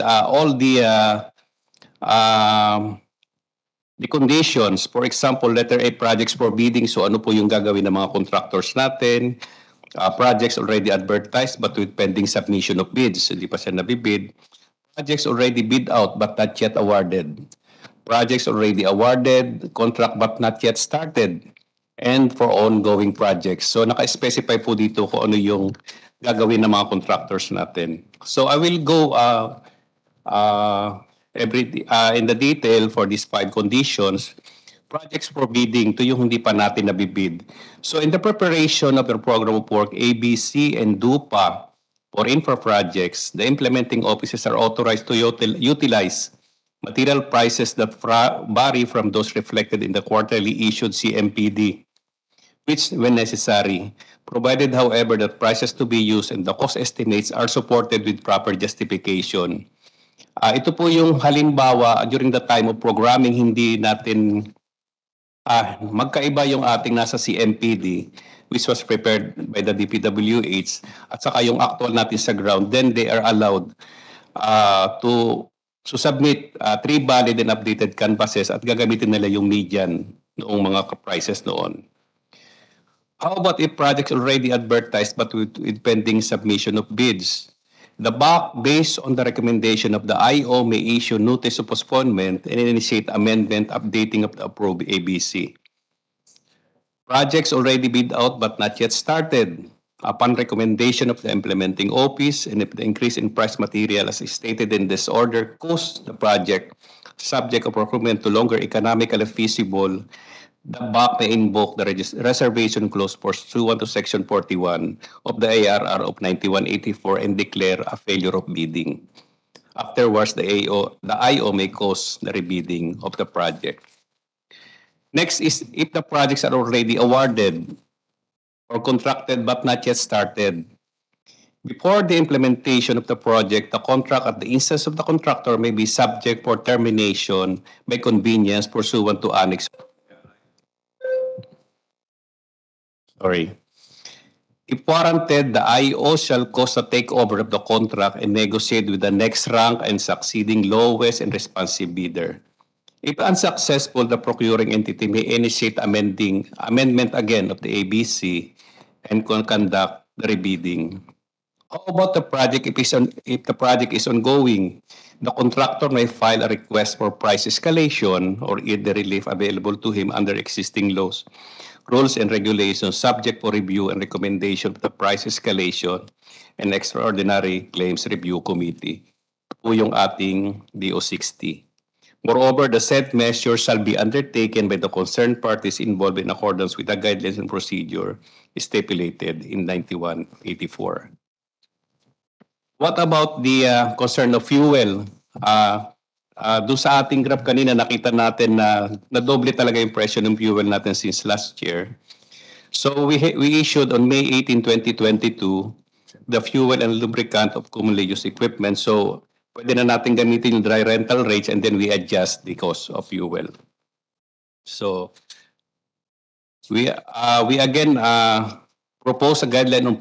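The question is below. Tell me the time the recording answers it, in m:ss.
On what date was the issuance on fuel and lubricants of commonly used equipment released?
3:24.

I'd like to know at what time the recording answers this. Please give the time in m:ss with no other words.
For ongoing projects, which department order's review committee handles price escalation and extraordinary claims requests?
3:00.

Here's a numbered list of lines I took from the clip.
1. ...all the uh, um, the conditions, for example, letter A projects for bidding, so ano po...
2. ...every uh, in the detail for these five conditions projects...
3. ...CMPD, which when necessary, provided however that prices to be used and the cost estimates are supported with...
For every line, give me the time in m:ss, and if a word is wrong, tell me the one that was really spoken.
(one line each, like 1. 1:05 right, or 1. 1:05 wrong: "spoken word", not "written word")
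1. 0:00 right
2. 0:31 right
3. 0:50 right.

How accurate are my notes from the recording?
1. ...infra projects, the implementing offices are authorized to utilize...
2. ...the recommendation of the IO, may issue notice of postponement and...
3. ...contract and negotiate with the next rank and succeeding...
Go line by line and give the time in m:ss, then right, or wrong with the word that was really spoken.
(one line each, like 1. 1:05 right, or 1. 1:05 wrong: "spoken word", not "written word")
1. 0:42 right
2. 1:29 right
3. 2:27 right.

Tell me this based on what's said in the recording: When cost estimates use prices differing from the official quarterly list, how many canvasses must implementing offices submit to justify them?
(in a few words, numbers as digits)
3.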